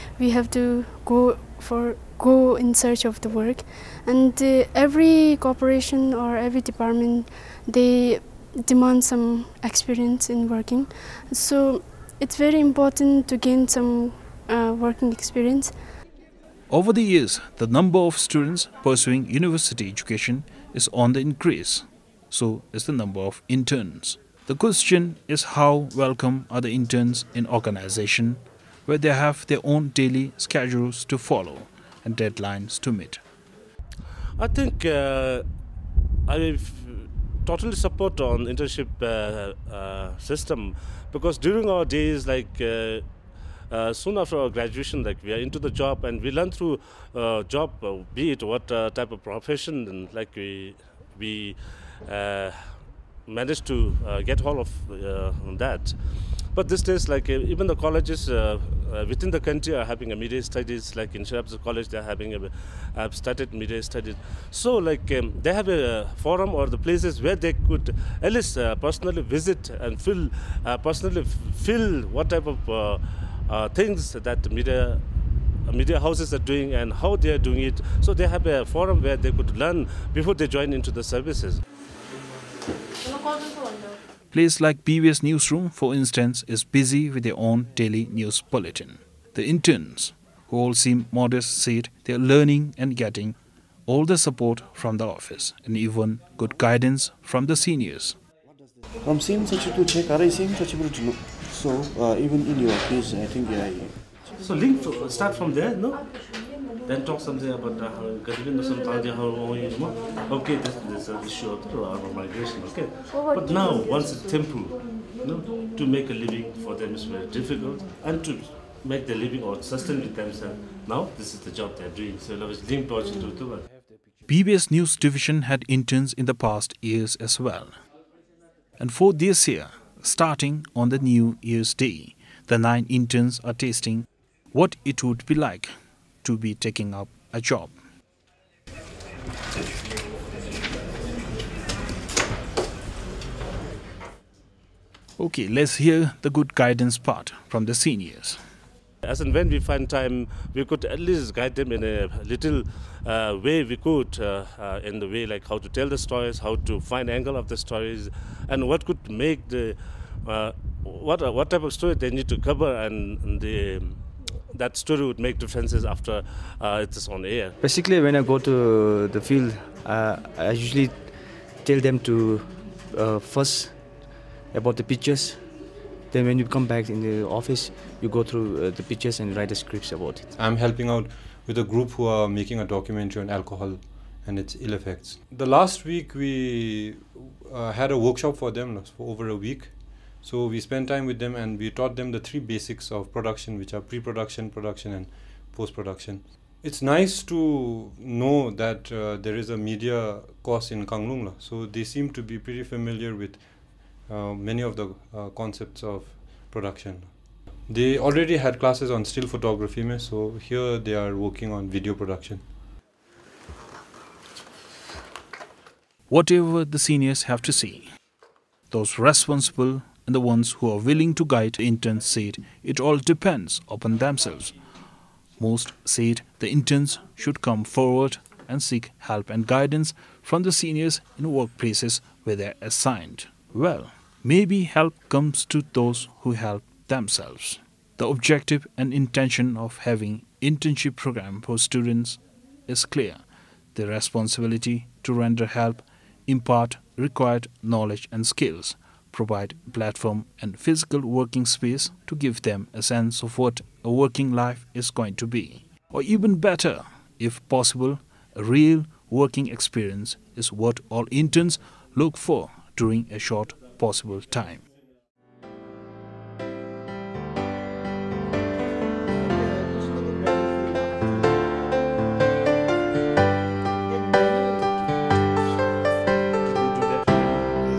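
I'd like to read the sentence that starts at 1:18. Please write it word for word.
So they have a forum where they could learn before they join into the services.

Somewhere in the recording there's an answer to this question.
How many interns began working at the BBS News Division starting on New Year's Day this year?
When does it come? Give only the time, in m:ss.
2:12.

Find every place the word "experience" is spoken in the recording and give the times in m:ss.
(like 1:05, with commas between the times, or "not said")
0:09, 0:15, 4:19.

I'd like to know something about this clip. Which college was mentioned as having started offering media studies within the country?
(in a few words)
Shirabs College.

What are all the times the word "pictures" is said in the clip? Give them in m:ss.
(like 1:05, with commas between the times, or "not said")
2:54, 2:58.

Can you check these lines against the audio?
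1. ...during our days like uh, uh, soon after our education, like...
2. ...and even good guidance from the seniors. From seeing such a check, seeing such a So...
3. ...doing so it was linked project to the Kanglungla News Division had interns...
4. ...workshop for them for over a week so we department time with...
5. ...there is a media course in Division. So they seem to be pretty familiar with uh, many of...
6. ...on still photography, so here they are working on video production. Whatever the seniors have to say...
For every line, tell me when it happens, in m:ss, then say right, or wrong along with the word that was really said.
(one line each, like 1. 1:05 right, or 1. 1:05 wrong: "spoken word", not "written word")
1. 0:41 wrong: "graduation", not "education"
2. 1:35 right
3. 2:02 wrong: "BBS", not "Kanglungla"
4. 3:07 wrong: "spent", not "department"
5. 3:19 wrong: "Kanglungla", not "Division"
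6. 3:28 right.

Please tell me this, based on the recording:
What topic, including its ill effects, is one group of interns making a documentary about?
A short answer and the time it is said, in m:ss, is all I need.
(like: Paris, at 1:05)
Alcohol, at 3:03.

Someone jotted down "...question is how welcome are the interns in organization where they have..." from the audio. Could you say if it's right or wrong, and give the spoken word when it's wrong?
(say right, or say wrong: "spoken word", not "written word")
right.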